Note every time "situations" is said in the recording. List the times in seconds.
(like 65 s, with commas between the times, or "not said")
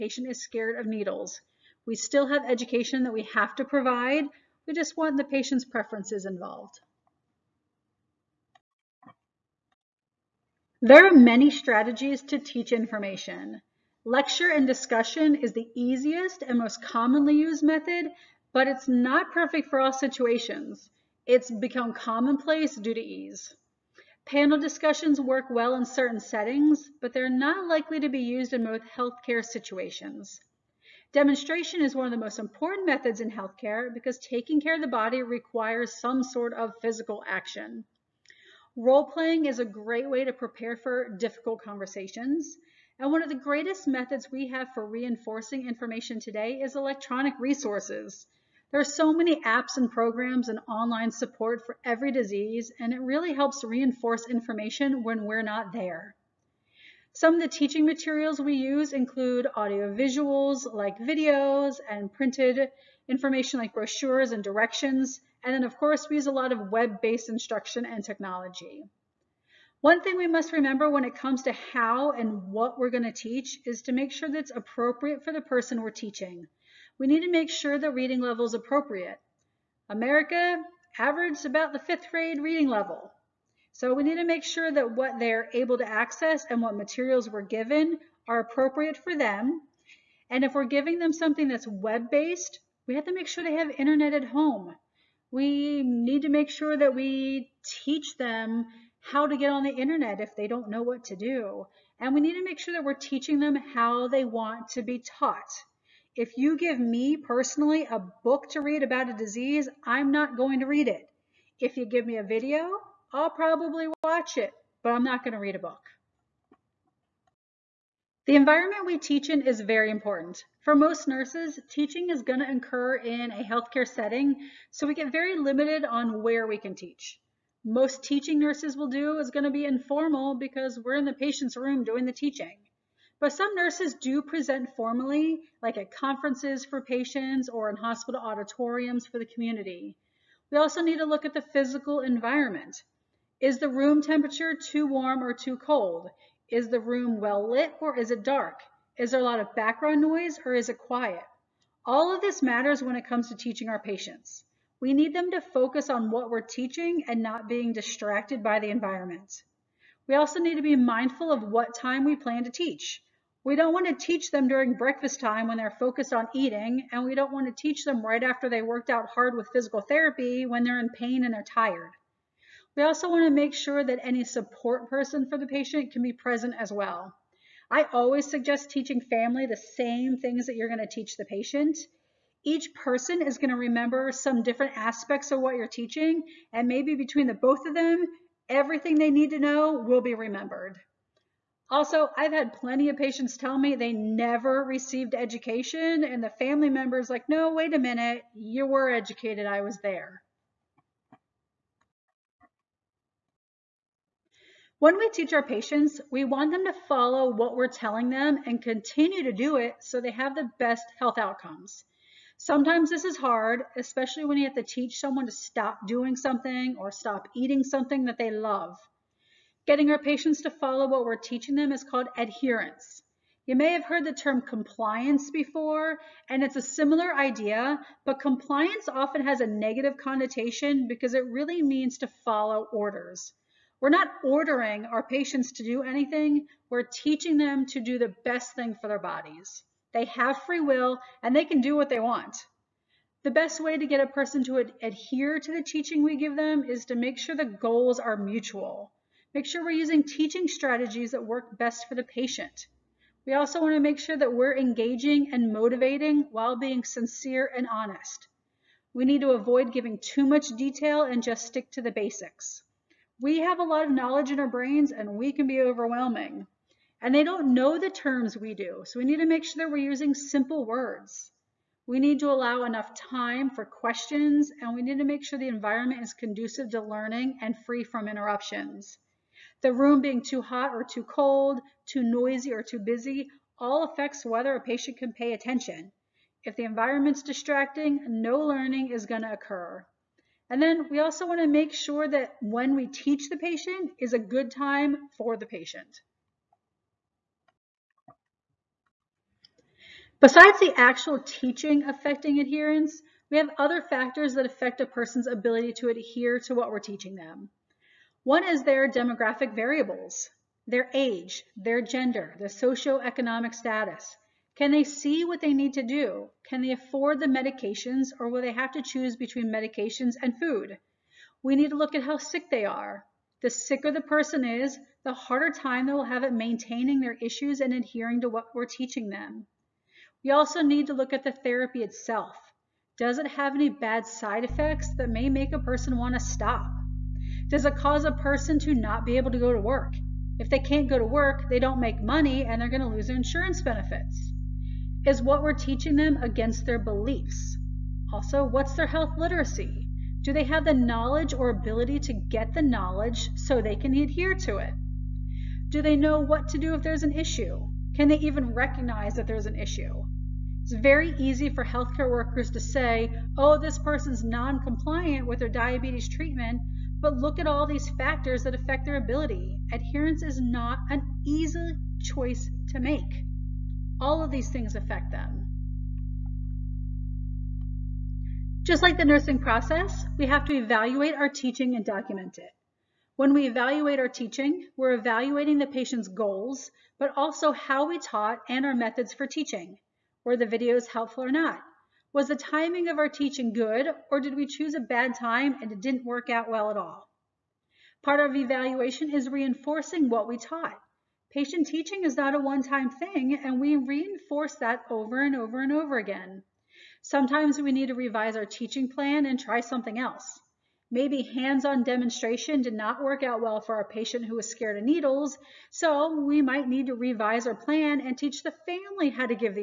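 19 s, 29 s.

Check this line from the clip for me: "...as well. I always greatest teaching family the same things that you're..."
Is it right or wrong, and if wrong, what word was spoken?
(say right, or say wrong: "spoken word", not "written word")
wrong: "suggest", not "greatest".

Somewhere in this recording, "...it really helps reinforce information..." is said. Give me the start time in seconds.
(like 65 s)
52 s.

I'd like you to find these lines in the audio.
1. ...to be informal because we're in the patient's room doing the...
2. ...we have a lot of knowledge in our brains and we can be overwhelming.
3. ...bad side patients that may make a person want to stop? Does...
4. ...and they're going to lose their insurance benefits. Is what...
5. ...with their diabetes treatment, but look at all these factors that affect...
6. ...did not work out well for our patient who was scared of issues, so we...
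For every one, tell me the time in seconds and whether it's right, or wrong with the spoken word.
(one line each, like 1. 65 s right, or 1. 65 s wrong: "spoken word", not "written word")
1. 129 s right
2. 263 s right
3. 333 s wrong: "effects", not "patients"
4. 342 s right
5. 365 s right
6. 412 s wrong: "needles", not "issues".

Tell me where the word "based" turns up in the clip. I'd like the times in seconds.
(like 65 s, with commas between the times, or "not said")
66 s, 91 s.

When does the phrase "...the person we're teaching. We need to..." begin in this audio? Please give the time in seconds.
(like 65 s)
75 s.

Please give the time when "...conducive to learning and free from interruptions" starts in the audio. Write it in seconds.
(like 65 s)
276 s.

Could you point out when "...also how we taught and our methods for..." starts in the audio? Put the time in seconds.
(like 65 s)
387 s.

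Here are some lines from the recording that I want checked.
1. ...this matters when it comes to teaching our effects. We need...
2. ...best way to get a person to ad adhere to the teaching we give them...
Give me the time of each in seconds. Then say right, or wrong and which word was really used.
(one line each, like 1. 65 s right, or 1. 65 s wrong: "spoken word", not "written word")
1. 152 s wrong: "patients", not "effects"
2. 243 s right.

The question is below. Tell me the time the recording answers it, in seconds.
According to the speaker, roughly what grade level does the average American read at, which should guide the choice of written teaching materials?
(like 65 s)
81 s.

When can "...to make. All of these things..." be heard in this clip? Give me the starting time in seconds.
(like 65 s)
372 s.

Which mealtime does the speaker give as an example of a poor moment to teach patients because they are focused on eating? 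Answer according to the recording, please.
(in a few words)
Breakfast.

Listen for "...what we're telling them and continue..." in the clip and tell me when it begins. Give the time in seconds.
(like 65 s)
207 s.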